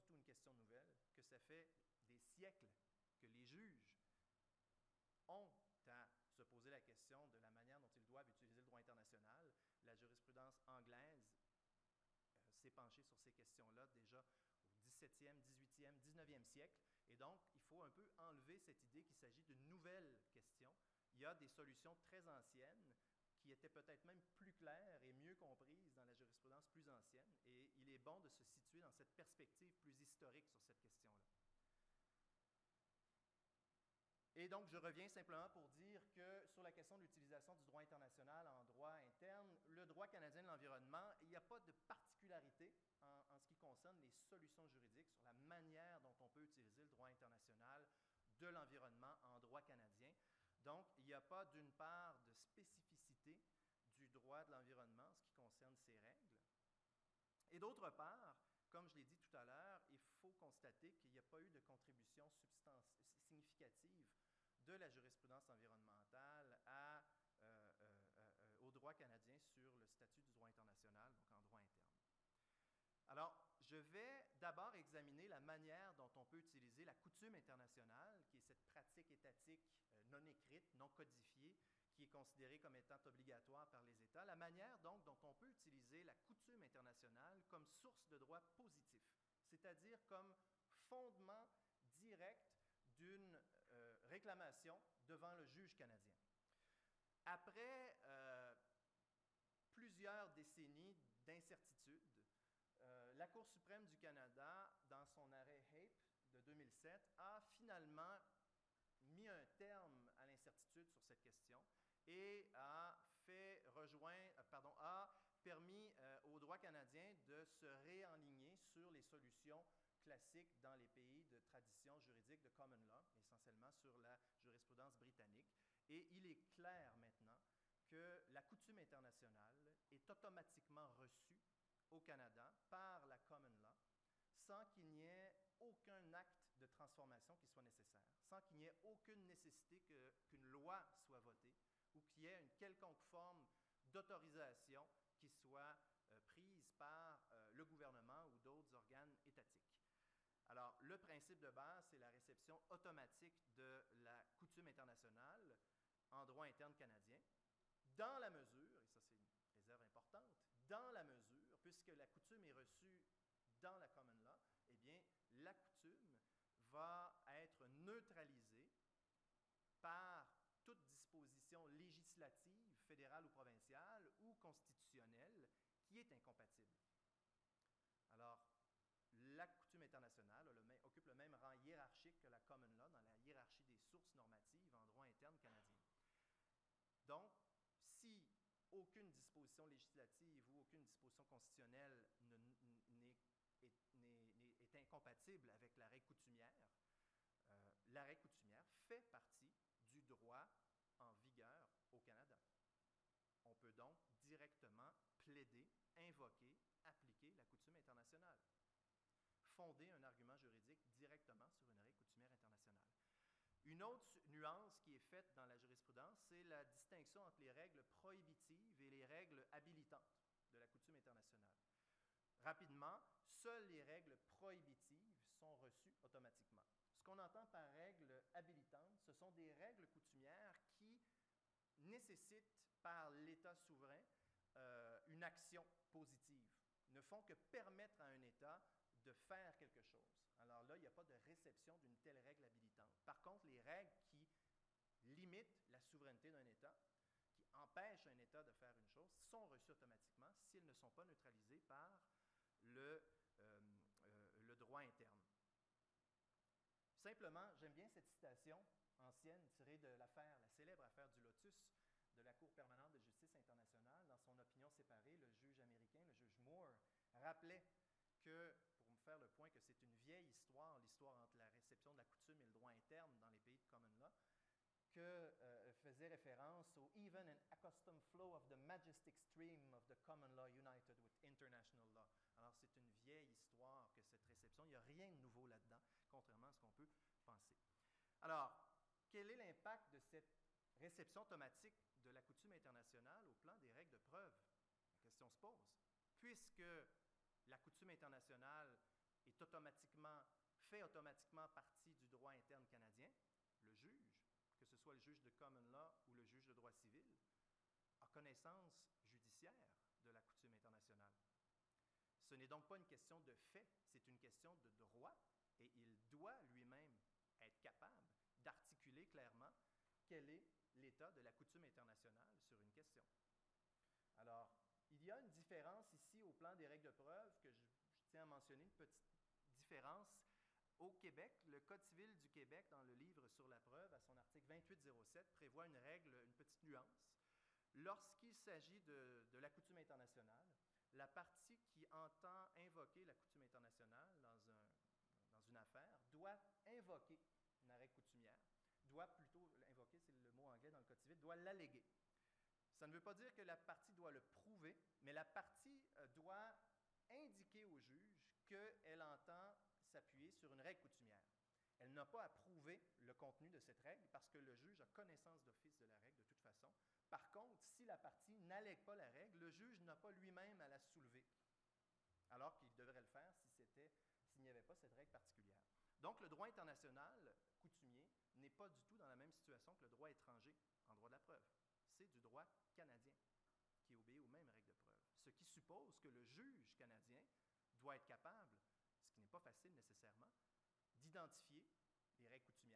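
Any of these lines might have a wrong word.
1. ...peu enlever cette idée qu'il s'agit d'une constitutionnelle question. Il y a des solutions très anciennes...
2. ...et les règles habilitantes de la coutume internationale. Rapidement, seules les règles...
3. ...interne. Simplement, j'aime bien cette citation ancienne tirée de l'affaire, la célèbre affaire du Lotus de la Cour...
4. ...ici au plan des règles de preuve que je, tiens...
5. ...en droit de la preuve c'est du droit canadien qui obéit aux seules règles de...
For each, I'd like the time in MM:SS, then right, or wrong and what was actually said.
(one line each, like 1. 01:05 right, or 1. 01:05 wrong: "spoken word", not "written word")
1. 00:17 wrong: "nouvelle", not "constitutionnelle"
2. 03:38 right
3. 04:14 right
4. 05:25 right
5. 06:20 wrong: "mêmes", not "seules".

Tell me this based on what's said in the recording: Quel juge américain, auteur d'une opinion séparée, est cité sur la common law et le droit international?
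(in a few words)
Moore.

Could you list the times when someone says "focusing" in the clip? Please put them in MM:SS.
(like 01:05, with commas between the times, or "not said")
not said.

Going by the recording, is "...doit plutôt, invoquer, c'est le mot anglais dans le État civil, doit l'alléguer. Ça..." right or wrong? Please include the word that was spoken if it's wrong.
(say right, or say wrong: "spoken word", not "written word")
wrong: "Code", not "État".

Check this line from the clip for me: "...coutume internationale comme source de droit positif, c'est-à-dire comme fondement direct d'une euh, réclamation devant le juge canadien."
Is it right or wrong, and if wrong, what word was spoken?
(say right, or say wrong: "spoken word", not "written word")
right.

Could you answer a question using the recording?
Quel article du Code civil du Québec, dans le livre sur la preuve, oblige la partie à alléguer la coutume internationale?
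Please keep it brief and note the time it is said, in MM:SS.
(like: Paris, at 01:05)
2807, at 05:34.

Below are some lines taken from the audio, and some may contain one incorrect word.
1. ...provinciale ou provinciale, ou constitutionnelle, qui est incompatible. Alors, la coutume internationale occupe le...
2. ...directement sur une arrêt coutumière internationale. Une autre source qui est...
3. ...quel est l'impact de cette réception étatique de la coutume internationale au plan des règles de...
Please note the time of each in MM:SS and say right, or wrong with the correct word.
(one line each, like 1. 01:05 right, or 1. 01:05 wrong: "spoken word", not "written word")
1. 02:52 wrong: "fédérale", not "provinciale"
2. 03:30 wrong: "nuance", not "source"
3. 04:49 wrong: "automatique", not "étatique".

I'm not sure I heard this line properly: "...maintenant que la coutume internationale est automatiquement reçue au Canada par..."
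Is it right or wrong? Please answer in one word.
right.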